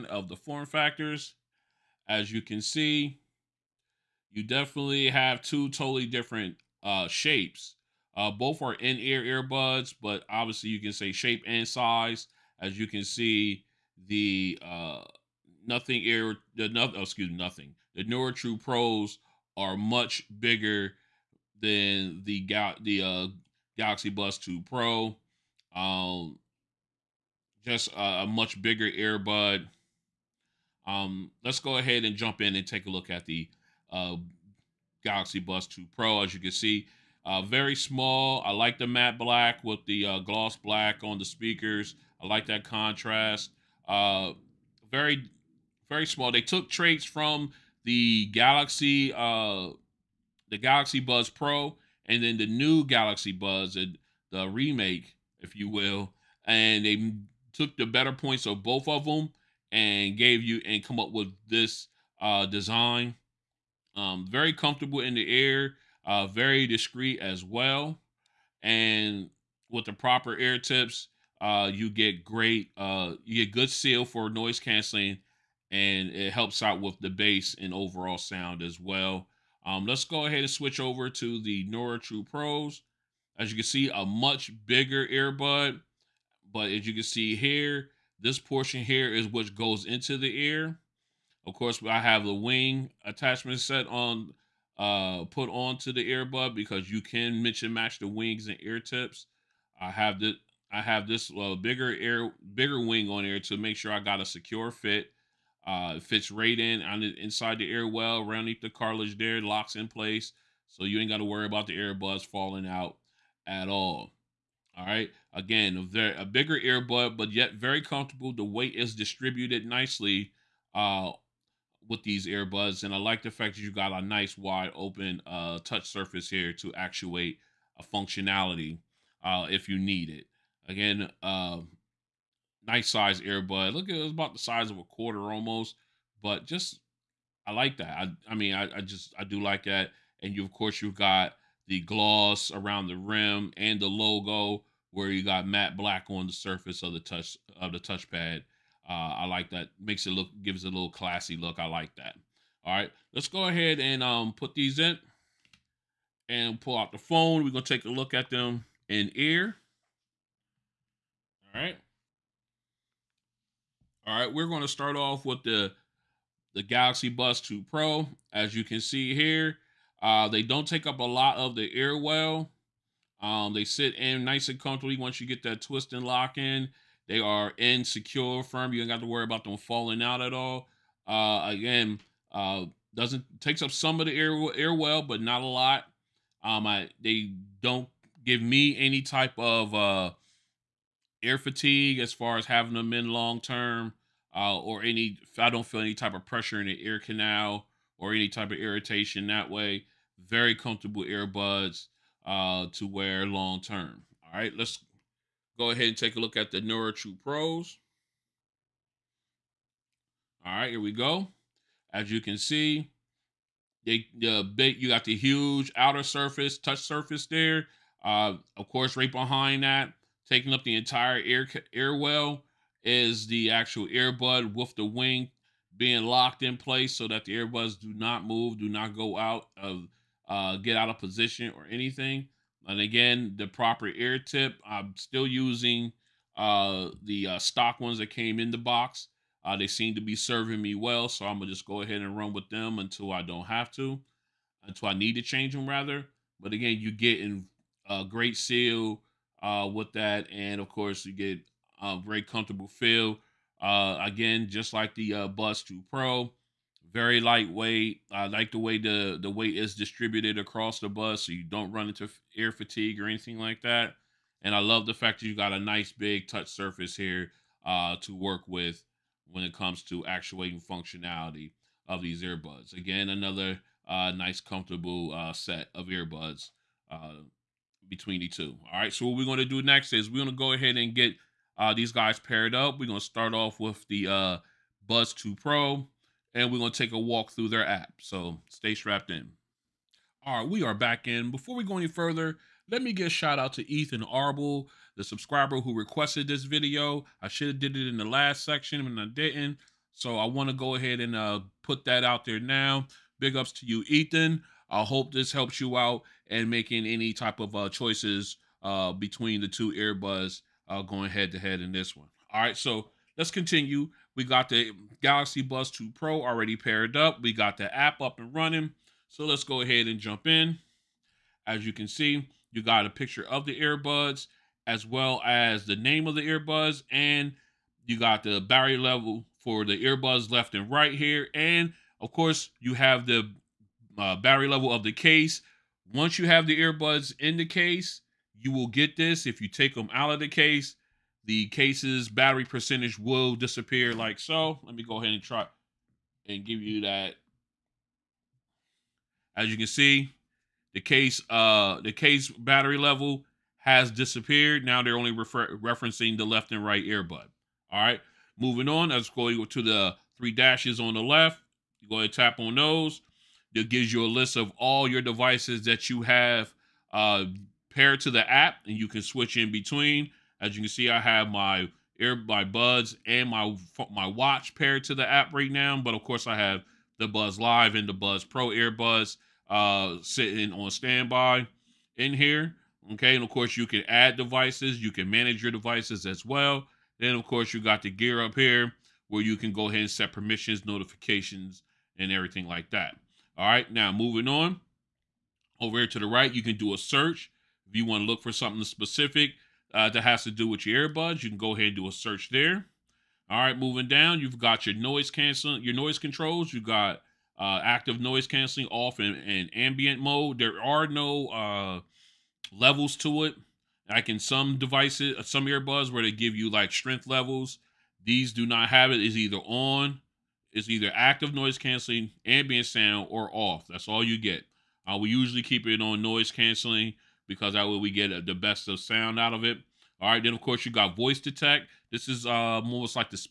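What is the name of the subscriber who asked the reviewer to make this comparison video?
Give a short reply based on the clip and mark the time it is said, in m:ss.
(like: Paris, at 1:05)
Ethan Arbel, at 4:53.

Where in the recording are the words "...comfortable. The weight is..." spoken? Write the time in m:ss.
1:57.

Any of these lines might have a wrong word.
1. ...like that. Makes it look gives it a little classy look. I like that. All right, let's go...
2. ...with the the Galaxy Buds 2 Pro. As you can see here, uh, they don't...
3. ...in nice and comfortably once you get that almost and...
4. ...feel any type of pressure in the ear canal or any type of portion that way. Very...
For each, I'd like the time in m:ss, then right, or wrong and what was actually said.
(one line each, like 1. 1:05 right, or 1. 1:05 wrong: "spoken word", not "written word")
1. 2:29 right
2. 2:45 right
3. 2:53 wrong: "twist", not "almost"
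4. 3:15 wrong: "irritation", not "portion".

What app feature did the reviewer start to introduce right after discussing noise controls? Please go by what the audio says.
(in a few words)
voice detect.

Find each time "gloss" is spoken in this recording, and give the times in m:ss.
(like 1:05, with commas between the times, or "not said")
0:40, 2:21.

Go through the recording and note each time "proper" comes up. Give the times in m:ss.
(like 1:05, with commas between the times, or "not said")
1:09, 3:53.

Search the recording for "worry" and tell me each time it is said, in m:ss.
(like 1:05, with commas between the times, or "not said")
1:51, 2:59.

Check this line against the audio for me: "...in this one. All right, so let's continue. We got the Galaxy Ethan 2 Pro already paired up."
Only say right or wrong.
wrong.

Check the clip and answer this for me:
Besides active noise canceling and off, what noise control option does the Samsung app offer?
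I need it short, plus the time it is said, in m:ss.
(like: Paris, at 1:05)
ambient mode, at 6:49.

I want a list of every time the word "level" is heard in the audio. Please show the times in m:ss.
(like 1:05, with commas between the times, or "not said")
5:28, 5:34, 5:52, 6:52, 6:57.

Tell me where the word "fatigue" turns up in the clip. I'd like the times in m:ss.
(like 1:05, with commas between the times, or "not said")
3:11, 4:22.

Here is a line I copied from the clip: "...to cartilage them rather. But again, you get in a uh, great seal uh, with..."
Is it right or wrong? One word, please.
wrong.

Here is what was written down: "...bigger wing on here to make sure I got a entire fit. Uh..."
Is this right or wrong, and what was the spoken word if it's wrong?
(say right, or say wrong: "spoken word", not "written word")
wrong: "secure", not "entire".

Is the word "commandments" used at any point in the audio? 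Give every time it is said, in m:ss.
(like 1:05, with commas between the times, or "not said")
not said.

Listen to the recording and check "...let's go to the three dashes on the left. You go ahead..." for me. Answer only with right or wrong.
right.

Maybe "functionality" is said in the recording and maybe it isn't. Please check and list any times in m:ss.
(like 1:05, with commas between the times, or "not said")
2:07, 4:30.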